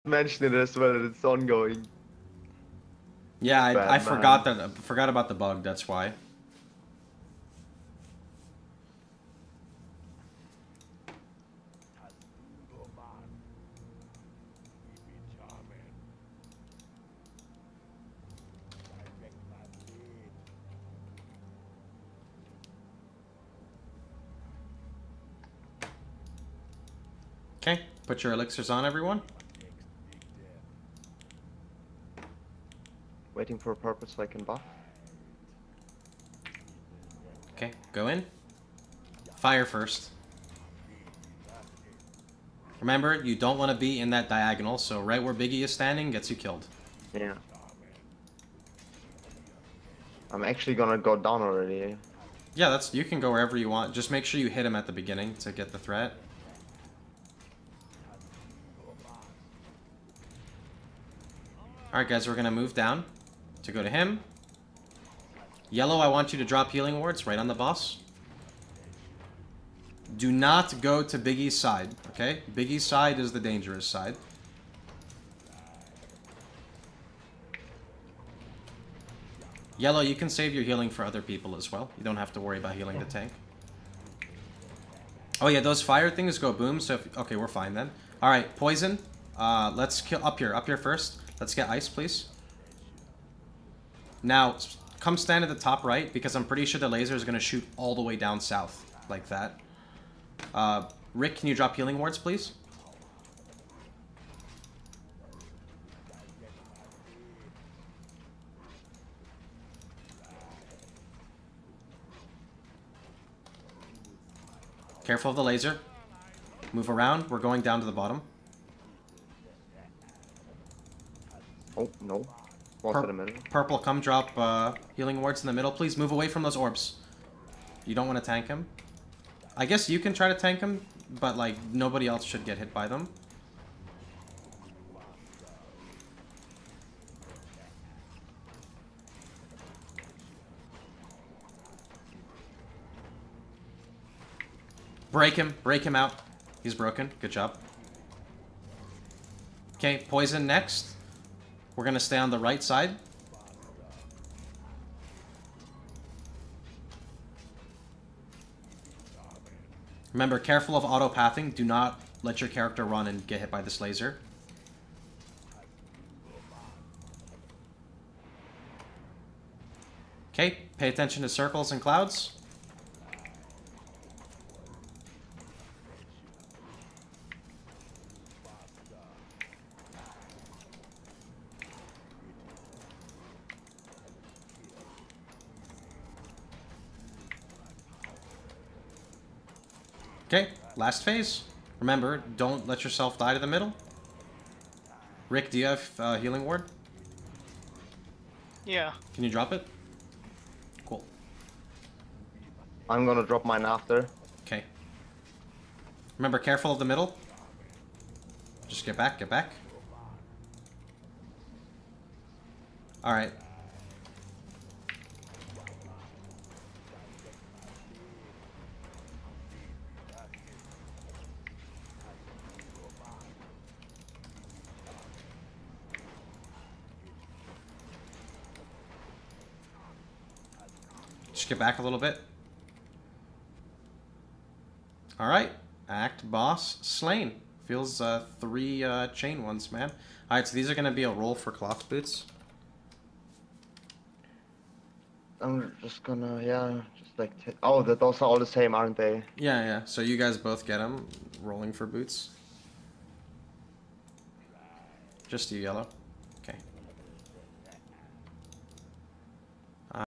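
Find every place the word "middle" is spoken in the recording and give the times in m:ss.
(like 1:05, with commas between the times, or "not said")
2:05, 3:13, 3:26.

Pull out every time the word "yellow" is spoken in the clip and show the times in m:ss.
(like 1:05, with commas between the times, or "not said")
1:05, 1:19, 4:15.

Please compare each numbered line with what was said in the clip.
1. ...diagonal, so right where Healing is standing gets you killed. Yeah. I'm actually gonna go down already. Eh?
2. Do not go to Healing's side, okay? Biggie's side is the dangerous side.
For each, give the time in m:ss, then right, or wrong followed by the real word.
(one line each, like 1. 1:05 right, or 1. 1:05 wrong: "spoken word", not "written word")
1. 0:44 wrong: "Biggie", not "Healing"
2. 1:10 wrong: "Biggie", not "Healing".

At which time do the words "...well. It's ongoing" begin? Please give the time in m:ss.
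0:00.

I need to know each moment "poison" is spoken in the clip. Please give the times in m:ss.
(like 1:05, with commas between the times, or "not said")
1:28, 2:30.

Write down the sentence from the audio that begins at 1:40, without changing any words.
Uh, Rick, can you drop healing wards, please?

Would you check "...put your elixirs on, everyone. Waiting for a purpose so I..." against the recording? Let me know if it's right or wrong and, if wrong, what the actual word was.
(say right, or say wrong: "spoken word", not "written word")
right.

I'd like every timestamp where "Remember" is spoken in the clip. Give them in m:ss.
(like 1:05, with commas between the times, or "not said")
0:42, 2:40, 3:11, 3:26.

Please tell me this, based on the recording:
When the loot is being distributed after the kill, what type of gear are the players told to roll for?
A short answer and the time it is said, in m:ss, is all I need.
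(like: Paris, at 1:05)
Cloth boots, at 4:01.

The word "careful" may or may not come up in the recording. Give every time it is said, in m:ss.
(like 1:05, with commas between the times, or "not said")
1:55, 2:40, 3:26.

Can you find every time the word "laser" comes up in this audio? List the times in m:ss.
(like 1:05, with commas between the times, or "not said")
1:36, 1:55, 2:43.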